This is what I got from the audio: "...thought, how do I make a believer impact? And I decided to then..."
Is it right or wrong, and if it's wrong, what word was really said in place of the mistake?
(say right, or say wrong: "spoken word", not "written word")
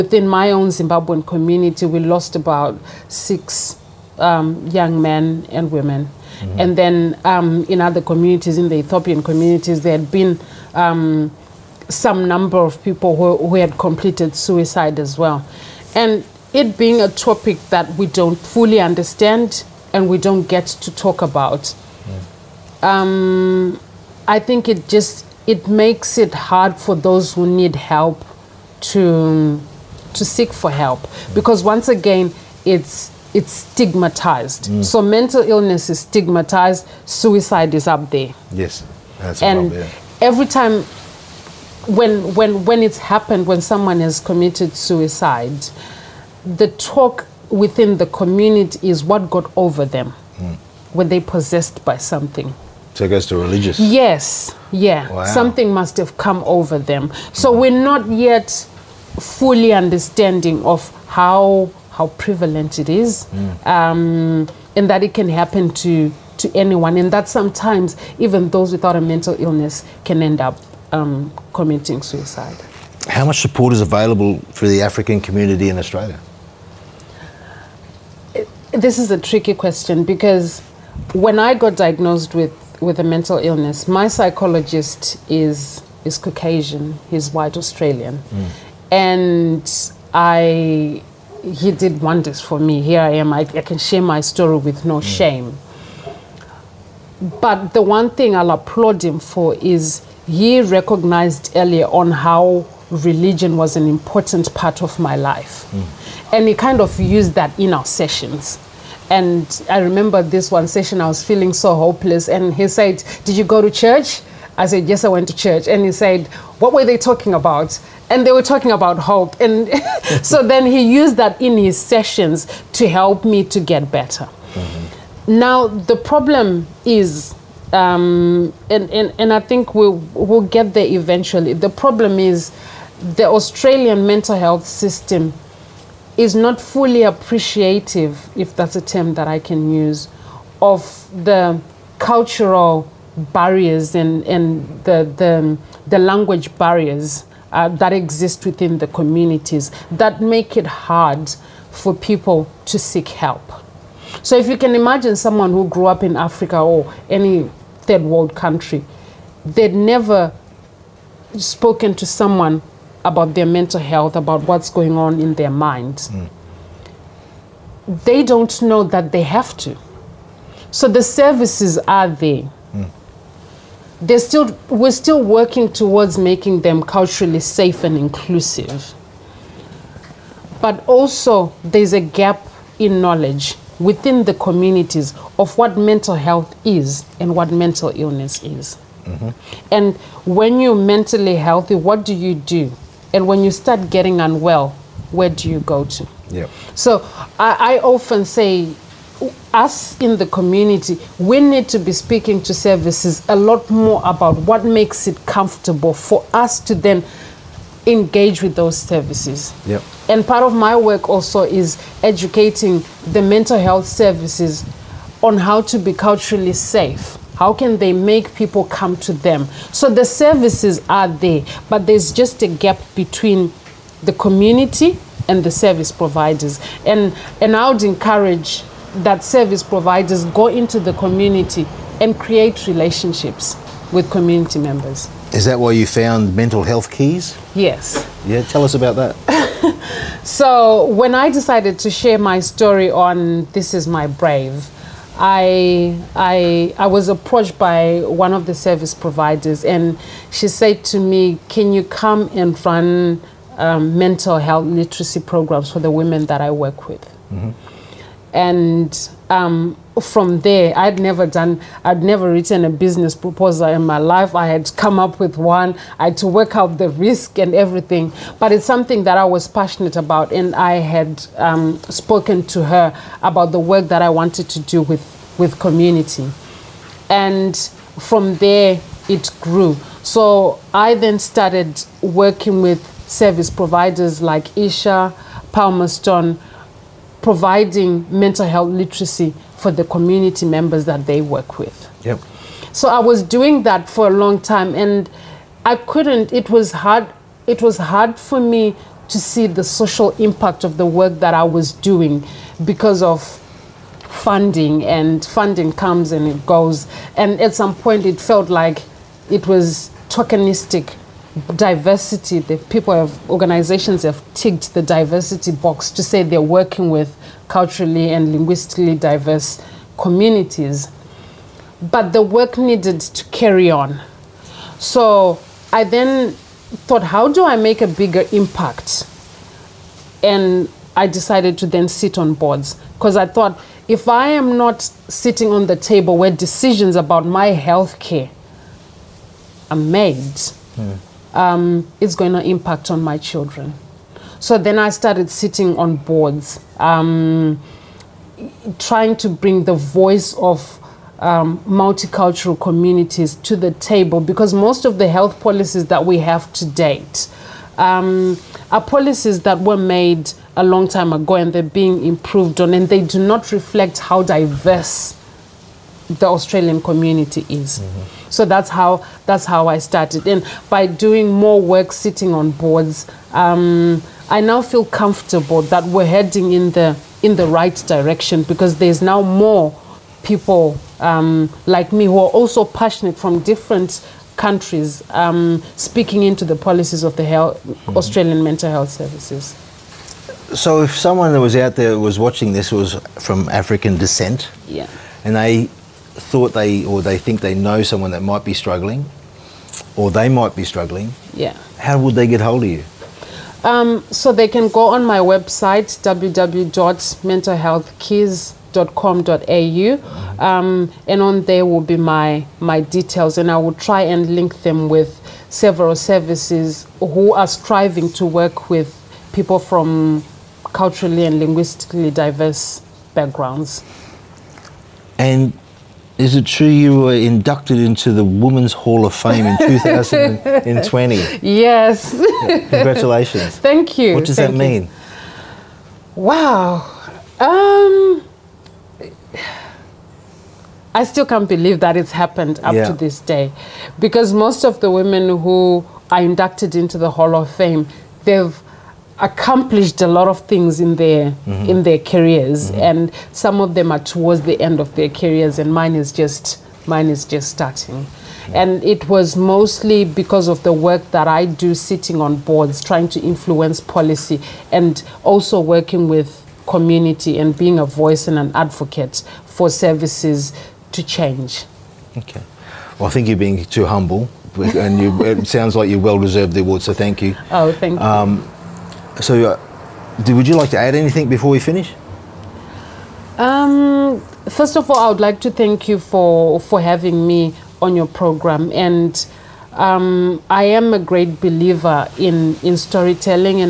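wrong: "bigger", not "believer".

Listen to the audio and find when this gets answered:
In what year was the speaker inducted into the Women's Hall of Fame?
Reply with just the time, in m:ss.
7:09.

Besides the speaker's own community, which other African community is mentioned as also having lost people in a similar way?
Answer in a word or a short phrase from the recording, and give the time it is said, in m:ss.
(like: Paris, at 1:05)
Ethiopian, at 0:08.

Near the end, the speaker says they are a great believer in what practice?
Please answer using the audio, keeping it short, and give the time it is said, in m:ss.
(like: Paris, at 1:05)
storytelling, at 8:12.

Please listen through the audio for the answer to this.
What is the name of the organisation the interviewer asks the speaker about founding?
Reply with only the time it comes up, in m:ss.
3:56.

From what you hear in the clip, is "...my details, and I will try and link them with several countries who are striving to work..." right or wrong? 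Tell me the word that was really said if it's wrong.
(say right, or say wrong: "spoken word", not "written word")
wrong: "services", not "countries".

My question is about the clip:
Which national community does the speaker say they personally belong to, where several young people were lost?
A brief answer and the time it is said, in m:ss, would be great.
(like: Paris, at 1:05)
Zimbabwean, at 0:00.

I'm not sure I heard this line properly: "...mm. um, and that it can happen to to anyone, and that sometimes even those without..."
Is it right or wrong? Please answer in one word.
right.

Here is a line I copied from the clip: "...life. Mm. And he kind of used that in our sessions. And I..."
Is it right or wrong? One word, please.
right.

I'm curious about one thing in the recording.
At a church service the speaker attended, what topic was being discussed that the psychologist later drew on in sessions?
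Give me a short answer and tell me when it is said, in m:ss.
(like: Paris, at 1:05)
hope, at 1:58.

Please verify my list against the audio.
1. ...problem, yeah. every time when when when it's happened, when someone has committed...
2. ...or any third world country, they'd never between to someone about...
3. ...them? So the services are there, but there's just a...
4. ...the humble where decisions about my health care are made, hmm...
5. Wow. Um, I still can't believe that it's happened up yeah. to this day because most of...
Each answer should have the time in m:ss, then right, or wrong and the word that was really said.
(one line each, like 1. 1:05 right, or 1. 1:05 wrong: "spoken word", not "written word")
1. 0:39 right
2. 2:36 wrong: "spoken", not "between"
3. 3:39 right
4. 5:35 wrong: "table", not "humble"
5. 7:16 right.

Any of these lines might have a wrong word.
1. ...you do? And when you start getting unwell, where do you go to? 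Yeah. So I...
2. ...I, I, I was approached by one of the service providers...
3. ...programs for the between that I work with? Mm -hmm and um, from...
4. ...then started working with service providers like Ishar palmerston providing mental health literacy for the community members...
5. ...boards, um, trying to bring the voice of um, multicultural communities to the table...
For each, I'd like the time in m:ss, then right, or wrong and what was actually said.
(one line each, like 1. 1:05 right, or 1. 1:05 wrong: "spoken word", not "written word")
1. 3:12 right
2. 4:05 right
3. 4:15 wrong: "women", not "between"
4. 4:40 right
5. 5:45 right.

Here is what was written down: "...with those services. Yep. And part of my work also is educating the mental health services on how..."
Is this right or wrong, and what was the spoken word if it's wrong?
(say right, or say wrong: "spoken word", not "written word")
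right.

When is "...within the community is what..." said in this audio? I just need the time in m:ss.
0:47.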